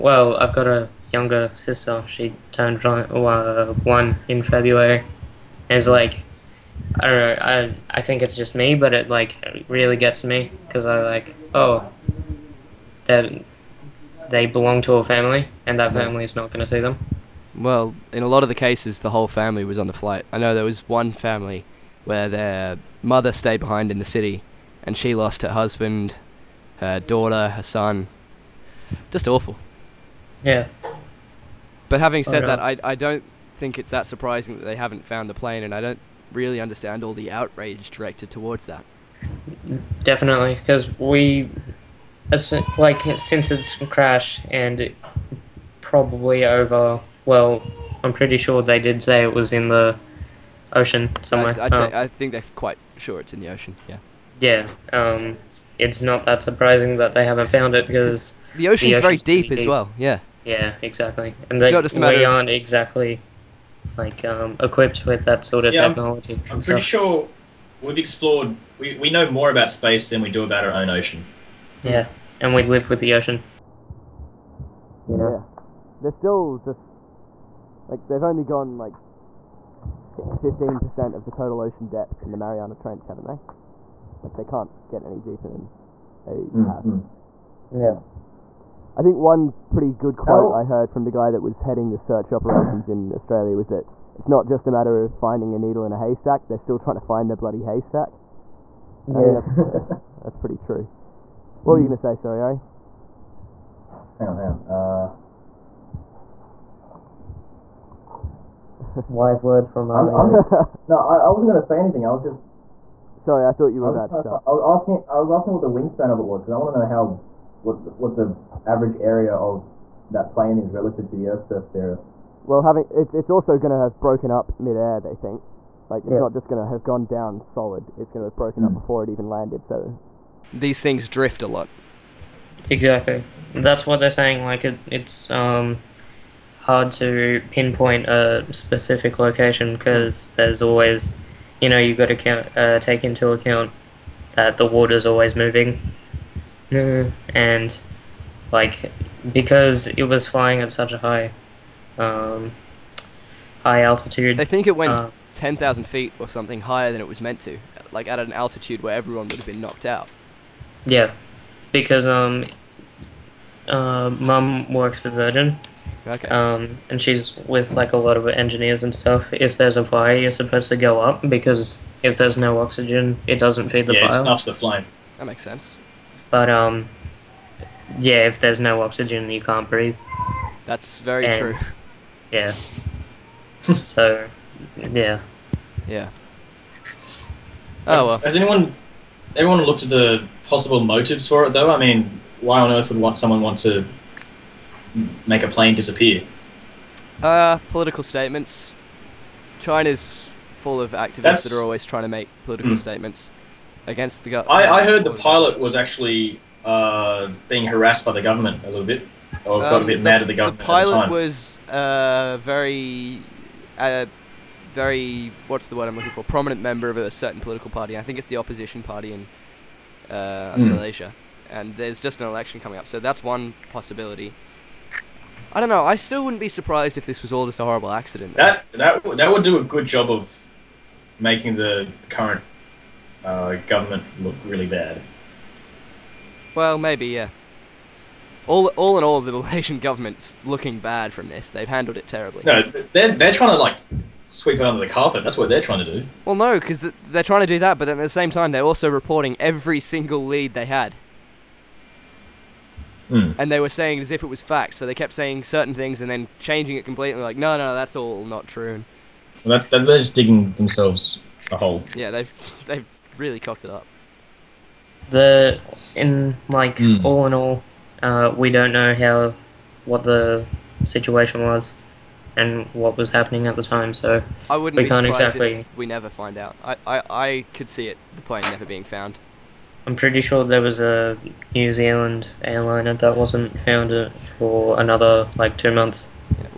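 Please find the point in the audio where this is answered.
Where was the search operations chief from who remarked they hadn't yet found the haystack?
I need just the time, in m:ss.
1:33.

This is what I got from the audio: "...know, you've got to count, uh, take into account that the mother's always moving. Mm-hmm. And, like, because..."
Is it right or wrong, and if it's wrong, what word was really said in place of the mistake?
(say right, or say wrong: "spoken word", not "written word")
wrong: "water", not "mother".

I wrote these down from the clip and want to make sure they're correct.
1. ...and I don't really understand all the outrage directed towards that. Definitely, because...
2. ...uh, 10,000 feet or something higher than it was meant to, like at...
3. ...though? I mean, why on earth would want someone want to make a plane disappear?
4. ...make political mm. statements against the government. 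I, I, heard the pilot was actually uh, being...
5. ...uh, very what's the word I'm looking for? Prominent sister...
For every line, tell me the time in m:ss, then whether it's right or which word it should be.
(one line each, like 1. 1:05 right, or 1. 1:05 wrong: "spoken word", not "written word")
1. 0:35 right
2. 2:34 right
3. 3:11 right
4. 3:22 right
5. 3:33 wrong: "member", not "sister".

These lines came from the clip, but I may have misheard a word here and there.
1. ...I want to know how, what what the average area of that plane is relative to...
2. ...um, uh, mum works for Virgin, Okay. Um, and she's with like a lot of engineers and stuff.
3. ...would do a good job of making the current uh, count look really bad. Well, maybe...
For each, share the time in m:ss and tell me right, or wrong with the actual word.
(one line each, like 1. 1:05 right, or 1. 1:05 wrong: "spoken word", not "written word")
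1. 1:56 right
2. 2:42 right
3. 3:49 wrong: "government", not "count".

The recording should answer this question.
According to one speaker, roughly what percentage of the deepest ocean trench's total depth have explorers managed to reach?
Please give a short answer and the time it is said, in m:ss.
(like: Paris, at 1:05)
15%, at 1:20.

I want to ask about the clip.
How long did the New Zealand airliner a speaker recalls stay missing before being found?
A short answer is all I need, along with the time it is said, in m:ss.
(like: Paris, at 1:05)
2 months, at 4:45.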